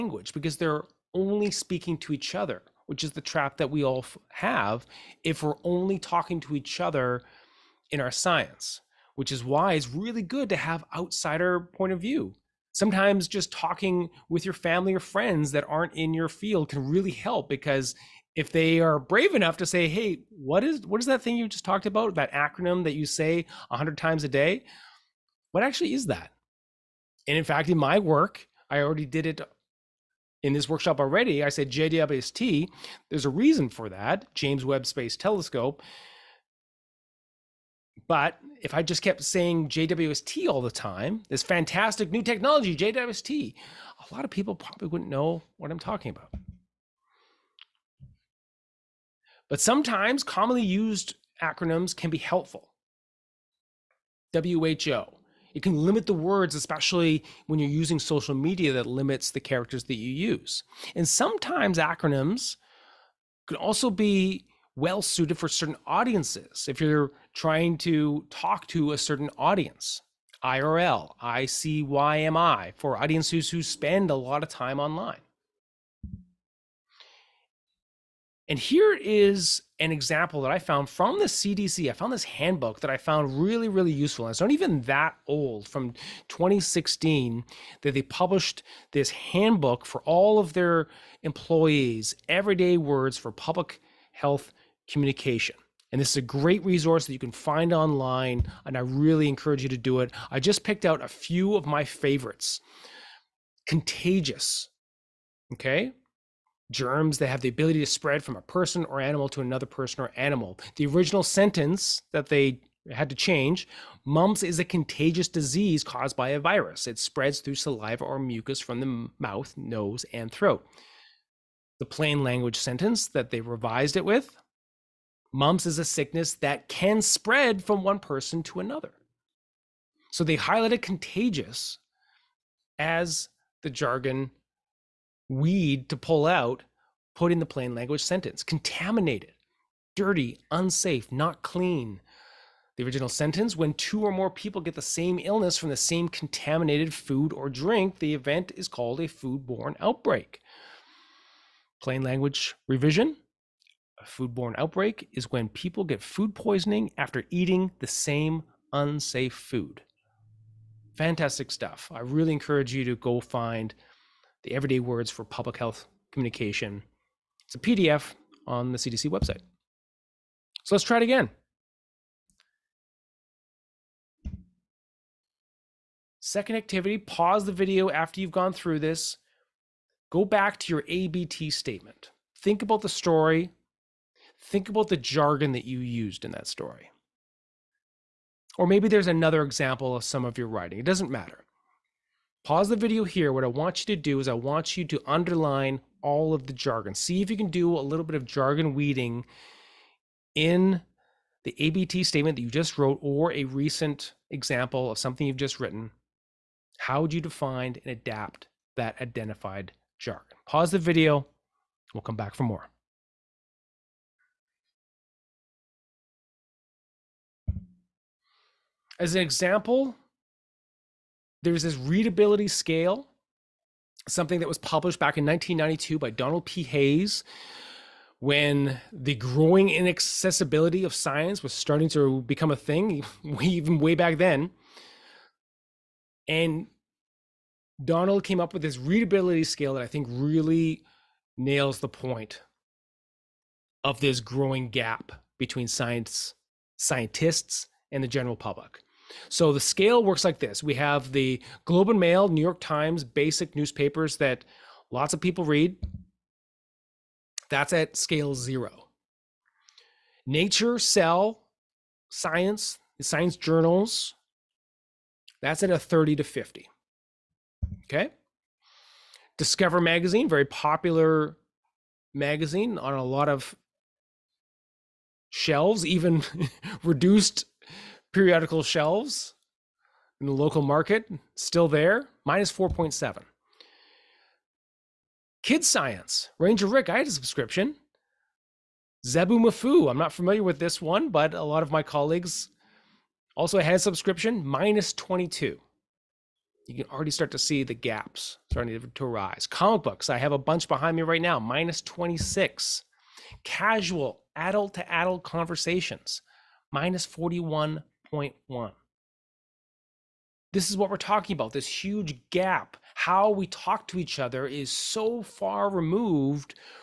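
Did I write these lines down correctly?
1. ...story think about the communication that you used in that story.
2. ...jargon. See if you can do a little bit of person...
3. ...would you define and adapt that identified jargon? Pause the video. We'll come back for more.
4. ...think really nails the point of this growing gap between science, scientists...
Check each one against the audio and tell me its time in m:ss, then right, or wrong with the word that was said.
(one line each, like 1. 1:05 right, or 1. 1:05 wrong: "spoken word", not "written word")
1. 3:02 wrong: "jargon", not "communication"
2. 3:16 wrong: "jargon", not "person"
3. 3:27 right
4. 3:59 right.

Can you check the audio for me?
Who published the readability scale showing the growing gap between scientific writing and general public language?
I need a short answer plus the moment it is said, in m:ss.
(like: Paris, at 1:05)
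Donald P. Hayes, at 3:46.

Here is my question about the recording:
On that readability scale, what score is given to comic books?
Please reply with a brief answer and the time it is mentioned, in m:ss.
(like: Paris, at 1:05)
-26, at 5:01.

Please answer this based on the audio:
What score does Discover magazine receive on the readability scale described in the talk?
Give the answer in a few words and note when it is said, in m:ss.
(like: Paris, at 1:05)
-4.7, at 4:42.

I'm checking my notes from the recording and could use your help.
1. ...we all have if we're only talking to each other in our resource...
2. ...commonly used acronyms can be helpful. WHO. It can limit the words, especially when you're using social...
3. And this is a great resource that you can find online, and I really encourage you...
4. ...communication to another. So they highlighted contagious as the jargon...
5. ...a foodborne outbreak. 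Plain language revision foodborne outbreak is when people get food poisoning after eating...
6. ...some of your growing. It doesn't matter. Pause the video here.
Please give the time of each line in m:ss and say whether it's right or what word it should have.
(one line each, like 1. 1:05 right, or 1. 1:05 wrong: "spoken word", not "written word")
1. 0:03 wrong: "science", not "resource"
2. 0:50 right
3. 1:35 right
4. 2:07 wrong: "person", not "communication"
5. 2:28 right
6. 3:10 wrong: "writing", not "growing".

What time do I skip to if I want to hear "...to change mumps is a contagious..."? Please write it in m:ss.
1:53.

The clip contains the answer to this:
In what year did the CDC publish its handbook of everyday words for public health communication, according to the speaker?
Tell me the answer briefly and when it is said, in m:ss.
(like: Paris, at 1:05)
2016, at 1:26.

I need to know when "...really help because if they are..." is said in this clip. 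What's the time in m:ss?
0:16.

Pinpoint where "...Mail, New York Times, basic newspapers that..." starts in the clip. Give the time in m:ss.
4:11.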